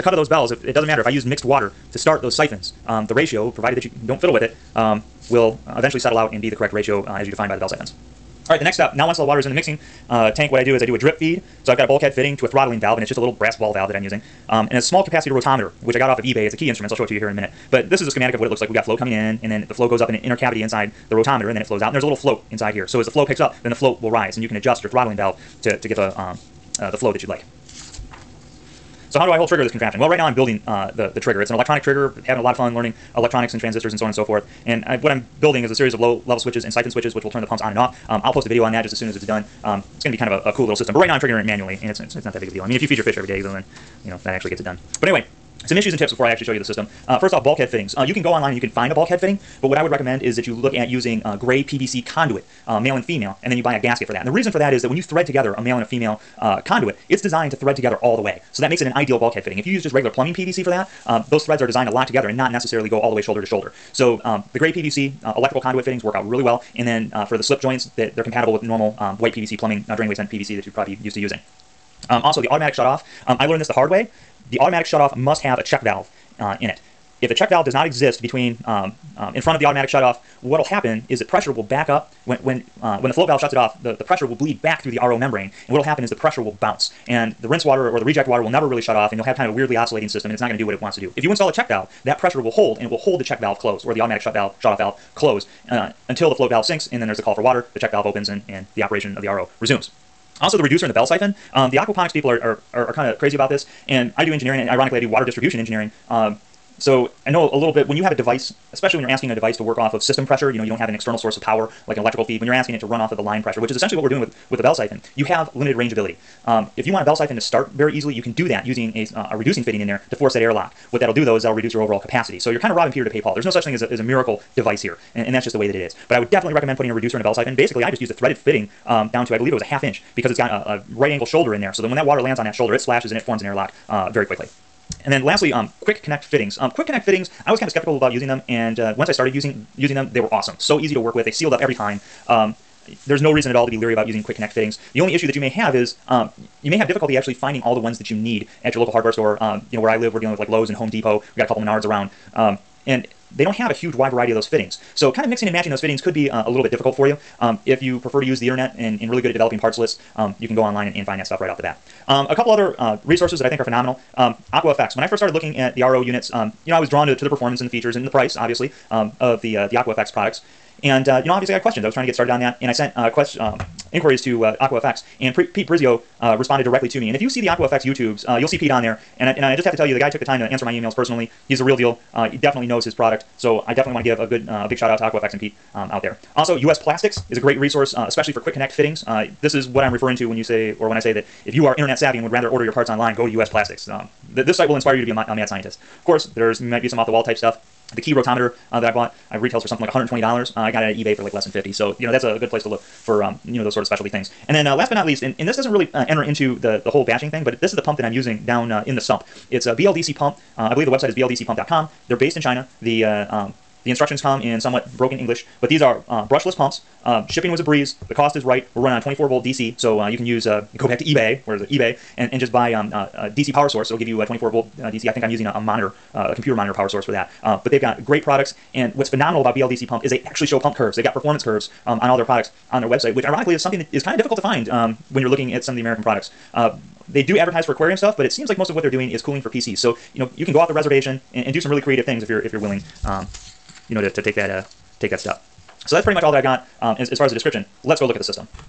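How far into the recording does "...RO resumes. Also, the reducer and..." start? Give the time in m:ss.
1:39.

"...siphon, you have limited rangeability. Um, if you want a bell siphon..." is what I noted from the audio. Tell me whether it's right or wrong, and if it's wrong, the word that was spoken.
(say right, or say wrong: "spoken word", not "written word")
right.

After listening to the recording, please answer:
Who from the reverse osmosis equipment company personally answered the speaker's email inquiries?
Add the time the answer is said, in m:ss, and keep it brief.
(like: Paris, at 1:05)
Pete Brizio, at 2:55.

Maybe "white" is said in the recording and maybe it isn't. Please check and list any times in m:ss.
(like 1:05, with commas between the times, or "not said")
1:09.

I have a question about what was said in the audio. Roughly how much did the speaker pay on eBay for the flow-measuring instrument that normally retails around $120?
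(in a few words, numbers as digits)
less than $50.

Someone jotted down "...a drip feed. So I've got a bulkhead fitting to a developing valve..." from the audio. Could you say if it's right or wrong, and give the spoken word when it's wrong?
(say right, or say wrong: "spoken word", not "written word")
wrong: "throttling", not "developing".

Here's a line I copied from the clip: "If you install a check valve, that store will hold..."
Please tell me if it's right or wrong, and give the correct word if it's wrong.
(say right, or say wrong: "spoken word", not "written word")
wrong: "pressure", not "store".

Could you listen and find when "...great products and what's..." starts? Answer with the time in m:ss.
3:48.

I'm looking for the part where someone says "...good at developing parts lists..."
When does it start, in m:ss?
2:39.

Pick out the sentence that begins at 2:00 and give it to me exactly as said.
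What that'll do though is that'll reduce your overall capacity.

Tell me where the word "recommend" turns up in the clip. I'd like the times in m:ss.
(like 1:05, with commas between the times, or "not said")
0:49, 2:06.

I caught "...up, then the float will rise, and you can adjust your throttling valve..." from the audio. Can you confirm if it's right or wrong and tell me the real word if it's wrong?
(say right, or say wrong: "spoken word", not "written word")
right.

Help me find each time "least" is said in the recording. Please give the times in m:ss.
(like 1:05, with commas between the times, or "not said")
3:25.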